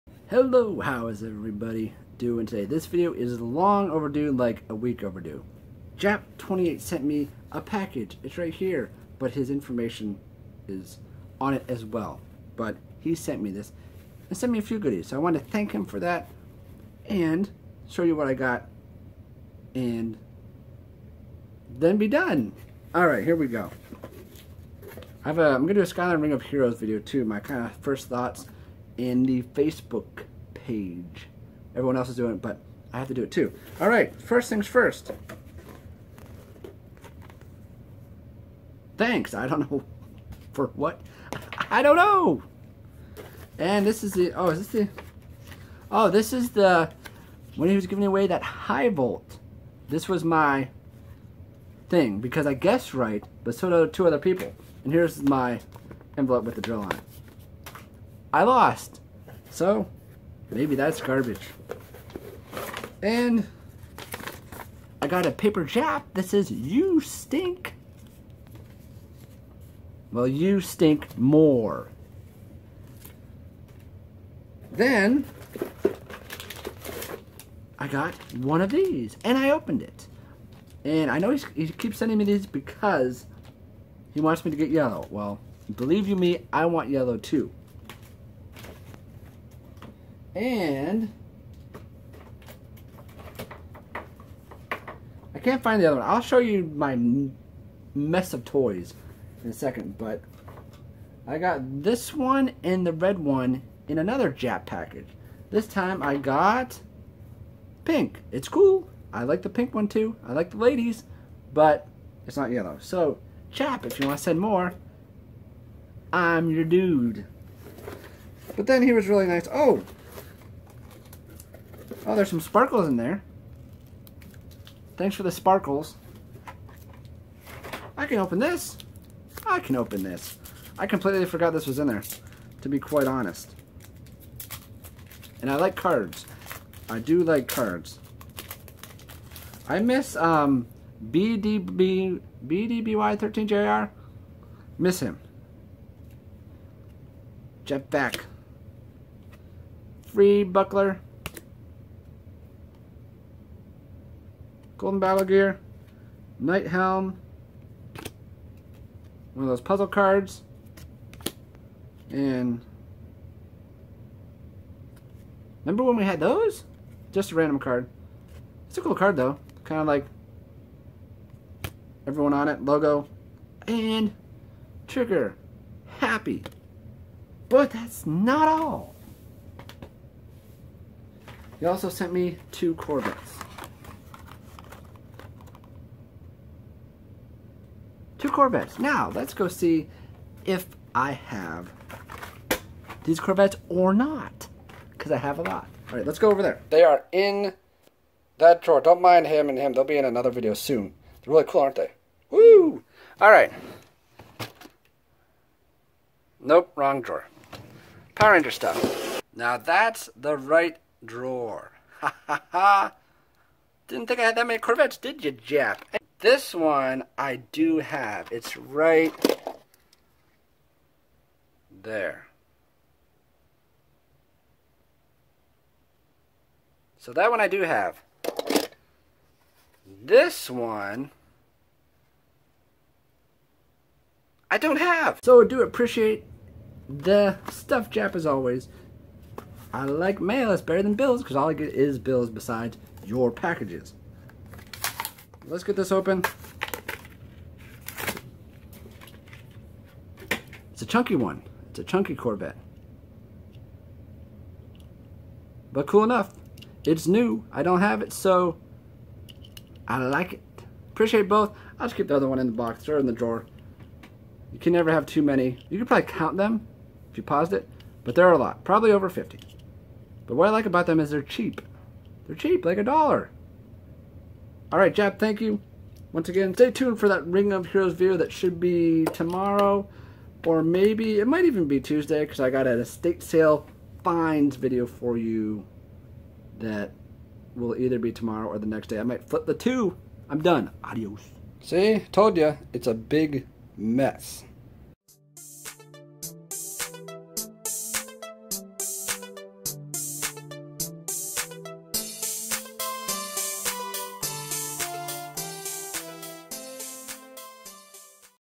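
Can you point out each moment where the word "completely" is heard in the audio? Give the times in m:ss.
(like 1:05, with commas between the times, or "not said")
2:10.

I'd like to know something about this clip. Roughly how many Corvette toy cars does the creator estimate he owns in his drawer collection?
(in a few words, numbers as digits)
Over 50.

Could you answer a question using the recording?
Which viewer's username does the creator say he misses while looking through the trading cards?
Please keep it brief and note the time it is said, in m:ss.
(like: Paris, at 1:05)
BDBY13JR, at 2:22.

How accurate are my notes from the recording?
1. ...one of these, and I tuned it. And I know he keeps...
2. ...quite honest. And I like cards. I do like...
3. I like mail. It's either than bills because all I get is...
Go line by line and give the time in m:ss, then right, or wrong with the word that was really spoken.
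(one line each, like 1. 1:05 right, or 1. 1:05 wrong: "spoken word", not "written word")
1. 1:18 wrong: "opened", not "tuned"
2. 2:12 right
3. 3:59 wrong: "better", not "either".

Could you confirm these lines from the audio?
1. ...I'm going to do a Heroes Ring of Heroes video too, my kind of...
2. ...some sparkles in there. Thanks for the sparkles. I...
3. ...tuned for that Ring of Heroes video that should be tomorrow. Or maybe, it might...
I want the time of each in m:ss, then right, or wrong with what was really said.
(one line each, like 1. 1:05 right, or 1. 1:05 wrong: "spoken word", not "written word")
1. 0:25 wrong: "Skyline", not "Heroes"
2. 2:02 right
3. 4:36 right.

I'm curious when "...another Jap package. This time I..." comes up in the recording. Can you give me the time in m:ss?
1:43.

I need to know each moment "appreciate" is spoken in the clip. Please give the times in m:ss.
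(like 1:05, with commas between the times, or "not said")
3:55, 4:20.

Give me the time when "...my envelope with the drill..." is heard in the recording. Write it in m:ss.
0:55.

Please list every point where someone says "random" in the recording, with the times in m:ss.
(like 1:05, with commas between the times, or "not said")
2:47.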